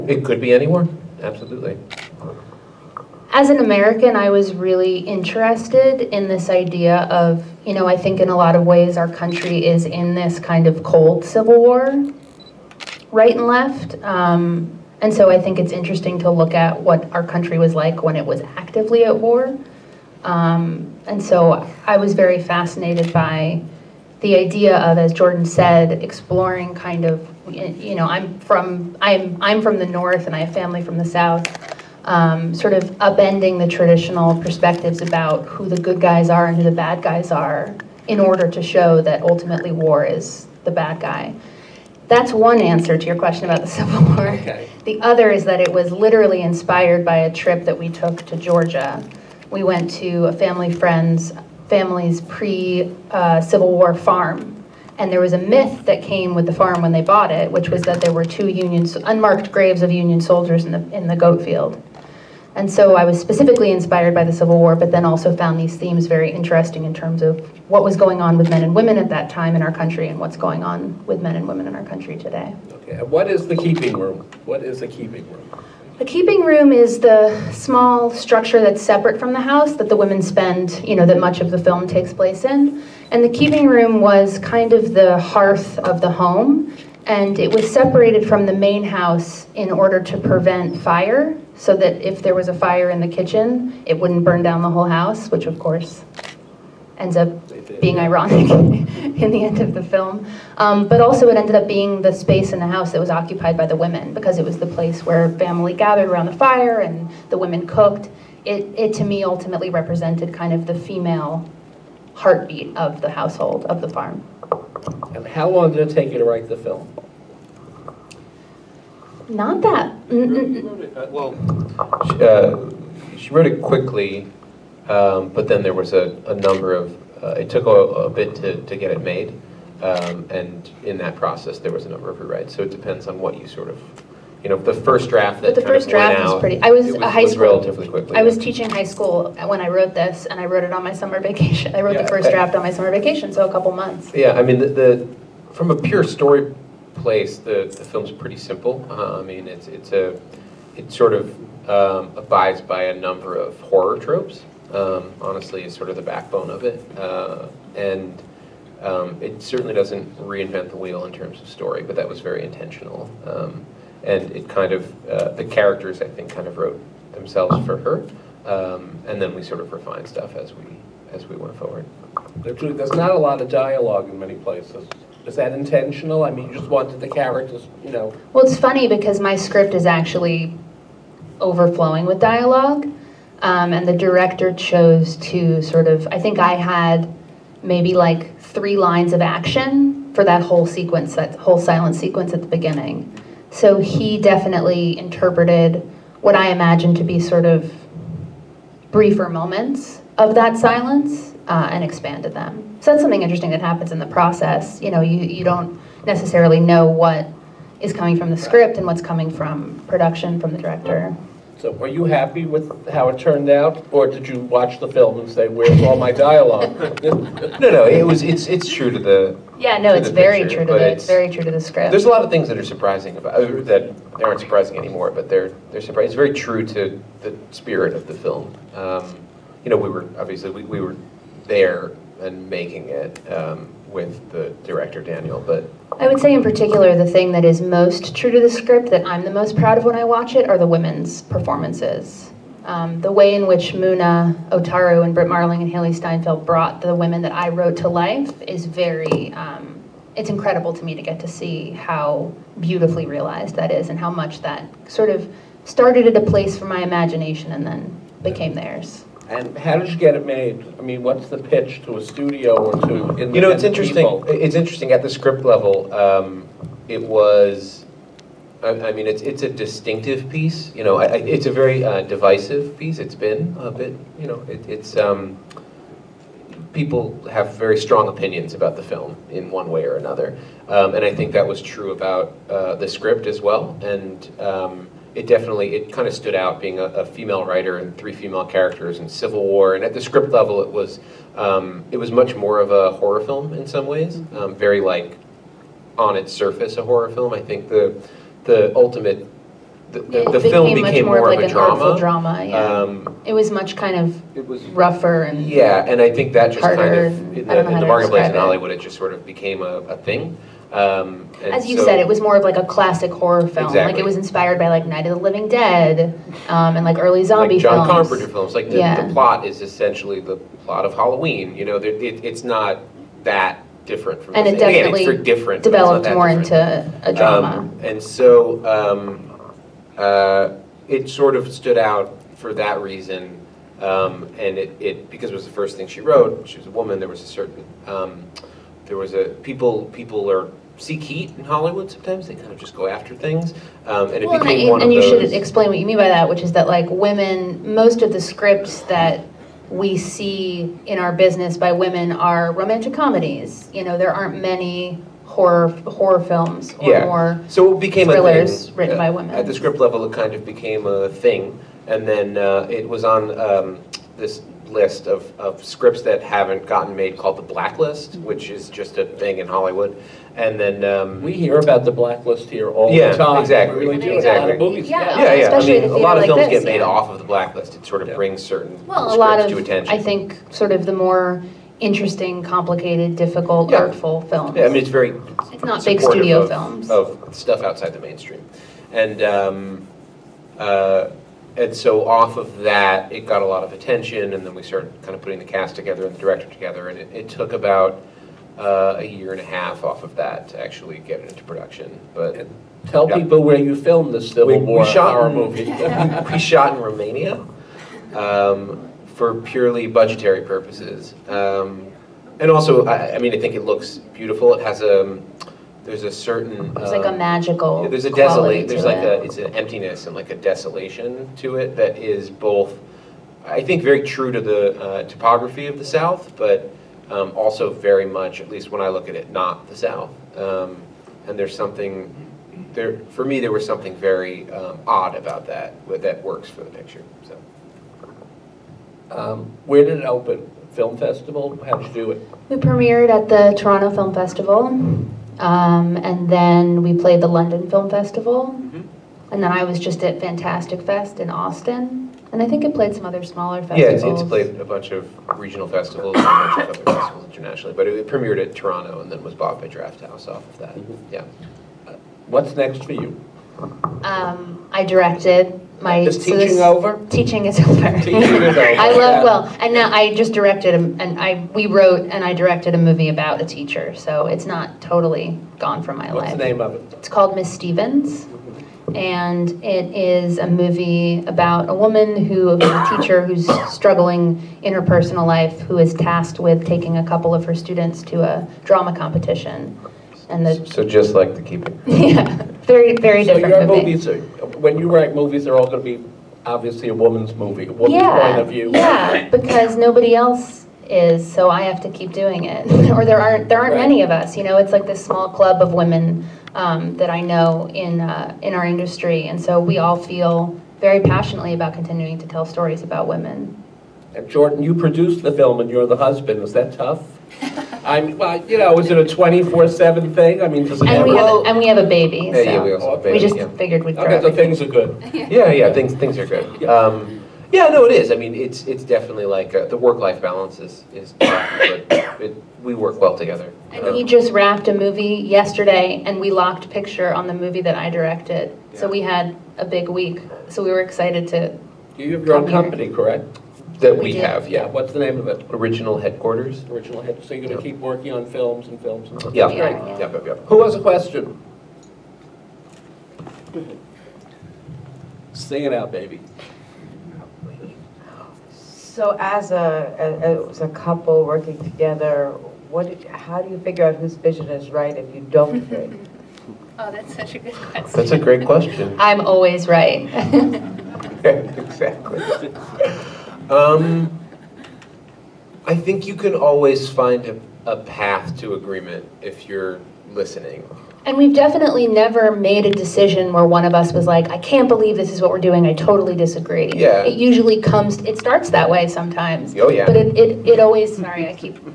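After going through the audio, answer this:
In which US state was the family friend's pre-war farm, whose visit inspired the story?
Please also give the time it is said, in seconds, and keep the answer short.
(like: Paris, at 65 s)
Georgia, at 48 s.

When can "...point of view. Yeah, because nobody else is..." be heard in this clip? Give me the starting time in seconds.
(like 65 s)
498 s.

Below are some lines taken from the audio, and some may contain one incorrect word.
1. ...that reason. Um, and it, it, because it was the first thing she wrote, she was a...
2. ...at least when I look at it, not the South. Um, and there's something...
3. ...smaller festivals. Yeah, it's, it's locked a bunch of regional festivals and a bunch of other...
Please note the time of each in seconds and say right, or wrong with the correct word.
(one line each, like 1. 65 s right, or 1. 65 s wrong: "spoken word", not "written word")
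1. 332 s right
2. 428 s right
3. 453 s wrong: "played", not "locked".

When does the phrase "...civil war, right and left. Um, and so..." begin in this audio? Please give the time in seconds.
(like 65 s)
11 s.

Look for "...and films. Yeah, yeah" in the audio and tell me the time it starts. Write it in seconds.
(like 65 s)
549 s.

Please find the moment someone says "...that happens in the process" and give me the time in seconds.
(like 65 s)
203 s.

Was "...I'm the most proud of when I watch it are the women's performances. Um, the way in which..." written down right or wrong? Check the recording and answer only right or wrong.
right.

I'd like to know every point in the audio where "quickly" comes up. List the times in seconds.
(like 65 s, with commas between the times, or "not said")
123 s, 137 s.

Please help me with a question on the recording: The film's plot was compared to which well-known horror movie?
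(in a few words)
Halloween.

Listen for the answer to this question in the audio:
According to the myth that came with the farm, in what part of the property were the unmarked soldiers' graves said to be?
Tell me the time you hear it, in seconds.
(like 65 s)
61 s.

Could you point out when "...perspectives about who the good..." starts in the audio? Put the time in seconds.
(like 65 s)
34 s.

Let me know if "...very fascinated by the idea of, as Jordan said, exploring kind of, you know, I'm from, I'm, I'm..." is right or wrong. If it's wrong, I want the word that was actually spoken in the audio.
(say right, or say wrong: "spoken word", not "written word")
right.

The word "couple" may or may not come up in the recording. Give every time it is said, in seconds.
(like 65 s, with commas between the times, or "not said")
143 s, 487 s, 560 s.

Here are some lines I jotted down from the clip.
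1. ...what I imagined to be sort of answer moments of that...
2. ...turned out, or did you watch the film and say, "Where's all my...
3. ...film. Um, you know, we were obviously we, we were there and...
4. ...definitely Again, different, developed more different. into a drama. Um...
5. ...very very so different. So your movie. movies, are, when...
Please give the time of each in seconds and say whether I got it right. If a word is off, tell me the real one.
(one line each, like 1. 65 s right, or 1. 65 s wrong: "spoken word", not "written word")
1. 196 s wrong: "briefer", not "answer"
2. 213 s right
3. 228 s right
4. 324 s right
5. 492 s right.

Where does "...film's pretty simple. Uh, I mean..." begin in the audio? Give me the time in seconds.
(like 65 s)
147 s.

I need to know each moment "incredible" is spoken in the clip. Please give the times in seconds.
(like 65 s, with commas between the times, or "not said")
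250 s.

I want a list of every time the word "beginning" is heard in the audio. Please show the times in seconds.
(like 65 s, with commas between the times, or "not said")
192 s.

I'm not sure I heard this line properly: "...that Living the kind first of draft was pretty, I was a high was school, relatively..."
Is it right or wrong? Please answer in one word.
wrong.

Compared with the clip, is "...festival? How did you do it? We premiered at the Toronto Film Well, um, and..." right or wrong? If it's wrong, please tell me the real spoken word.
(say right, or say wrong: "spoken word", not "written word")
wrong: "Festival", not "Well".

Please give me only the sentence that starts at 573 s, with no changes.
Um, I think you can always find a, a path to agreement if you're listening.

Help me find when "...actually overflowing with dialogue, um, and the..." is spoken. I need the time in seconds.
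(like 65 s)
179 s.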